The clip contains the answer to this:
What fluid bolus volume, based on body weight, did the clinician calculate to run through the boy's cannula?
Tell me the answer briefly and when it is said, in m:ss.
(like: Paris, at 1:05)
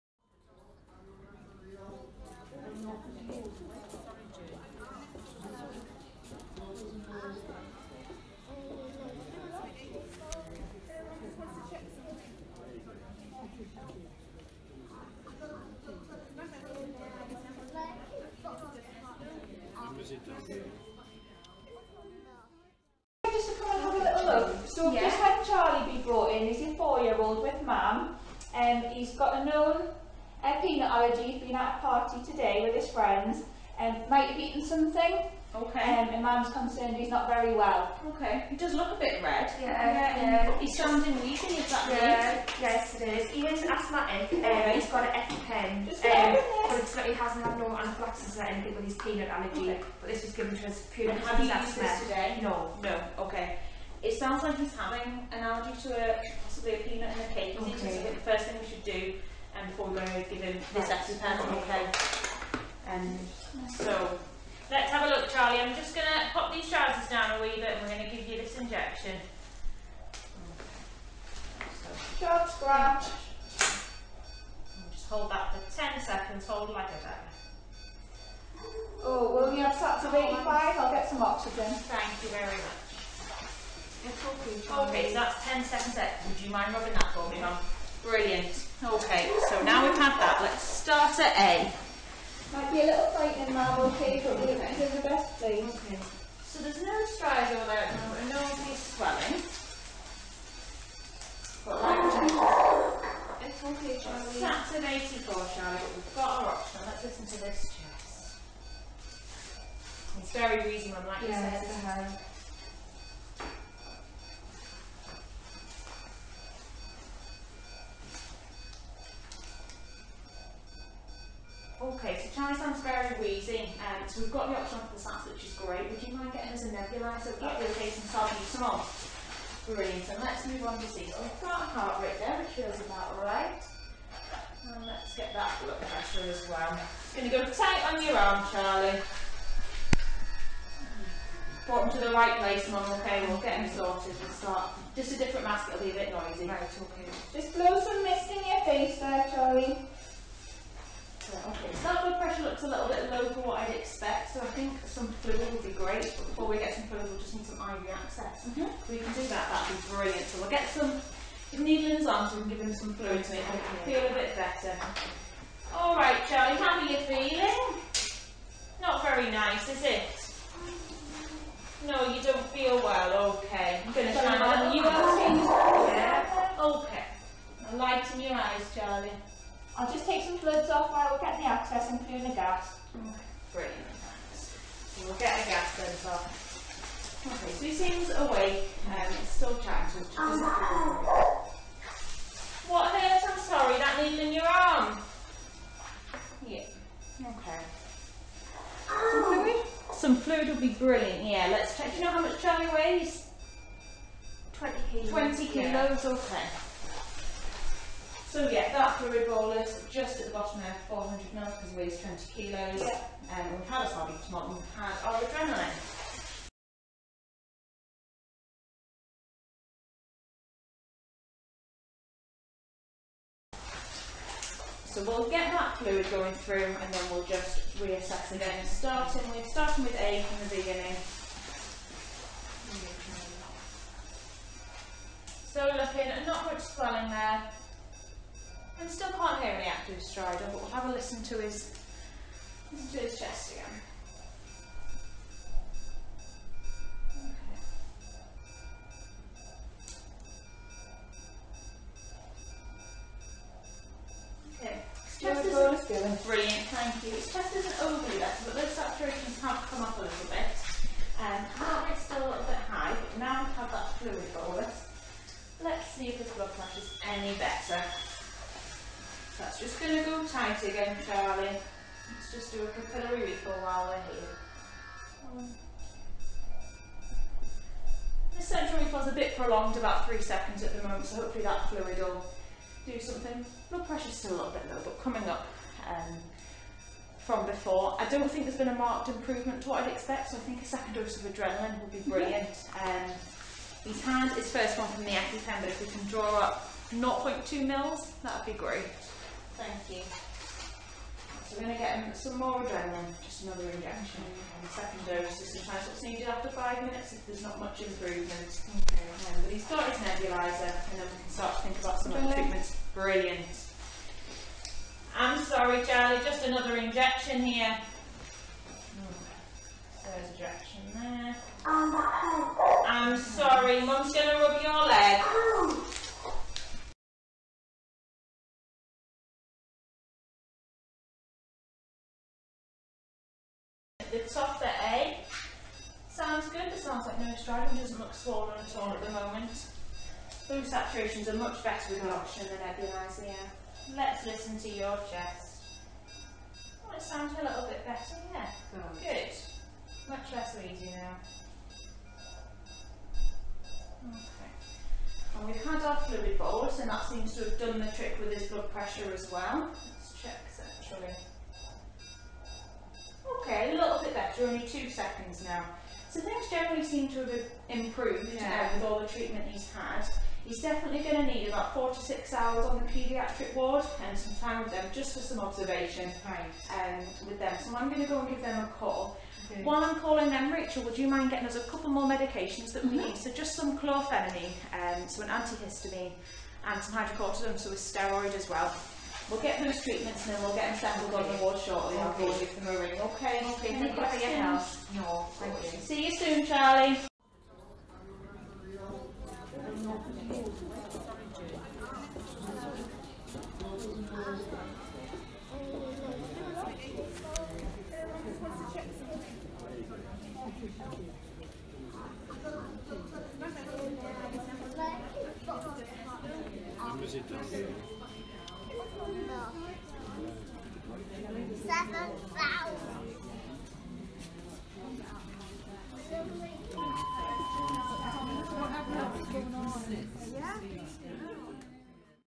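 400 ml, at 3:30.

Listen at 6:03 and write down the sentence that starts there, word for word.
Okay, a little bit better, only two seconds now.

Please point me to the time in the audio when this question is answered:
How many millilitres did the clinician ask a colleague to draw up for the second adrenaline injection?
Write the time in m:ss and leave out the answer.
4:56.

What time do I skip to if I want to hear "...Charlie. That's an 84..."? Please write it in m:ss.
1:44.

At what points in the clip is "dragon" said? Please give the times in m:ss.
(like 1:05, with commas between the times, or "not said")
5:37.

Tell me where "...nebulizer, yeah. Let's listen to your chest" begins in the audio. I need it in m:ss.
5:42.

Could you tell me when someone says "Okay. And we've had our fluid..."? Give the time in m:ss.
5:54.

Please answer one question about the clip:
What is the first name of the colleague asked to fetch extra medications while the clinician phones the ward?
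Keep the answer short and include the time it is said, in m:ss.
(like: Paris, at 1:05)
Rachel, at 6:20.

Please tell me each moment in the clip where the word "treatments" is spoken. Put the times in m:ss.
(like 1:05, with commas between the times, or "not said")
5:12, 6:09, 6:29.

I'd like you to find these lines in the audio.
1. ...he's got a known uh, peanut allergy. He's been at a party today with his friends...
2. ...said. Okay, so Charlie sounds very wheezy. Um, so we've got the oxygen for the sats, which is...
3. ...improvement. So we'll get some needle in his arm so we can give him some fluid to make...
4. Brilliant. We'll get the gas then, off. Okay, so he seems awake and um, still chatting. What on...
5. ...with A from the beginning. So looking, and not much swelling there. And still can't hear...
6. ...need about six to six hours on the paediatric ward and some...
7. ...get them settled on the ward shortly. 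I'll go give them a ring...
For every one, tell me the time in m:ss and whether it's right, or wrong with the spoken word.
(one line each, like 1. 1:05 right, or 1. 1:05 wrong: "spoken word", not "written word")
1. 0:28 right
2. 1:51 right
3. 2:39 wrong: "brilliant", not "improvement"
4. 3:03 right
5. 3:49 right
6. 6:11 wrong: "four", not "six"
7. 6:30 right.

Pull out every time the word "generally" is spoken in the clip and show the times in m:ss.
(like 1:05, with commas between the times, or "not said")
6:06.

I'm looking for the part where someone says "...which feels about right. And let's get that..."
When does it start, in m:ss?
2:12.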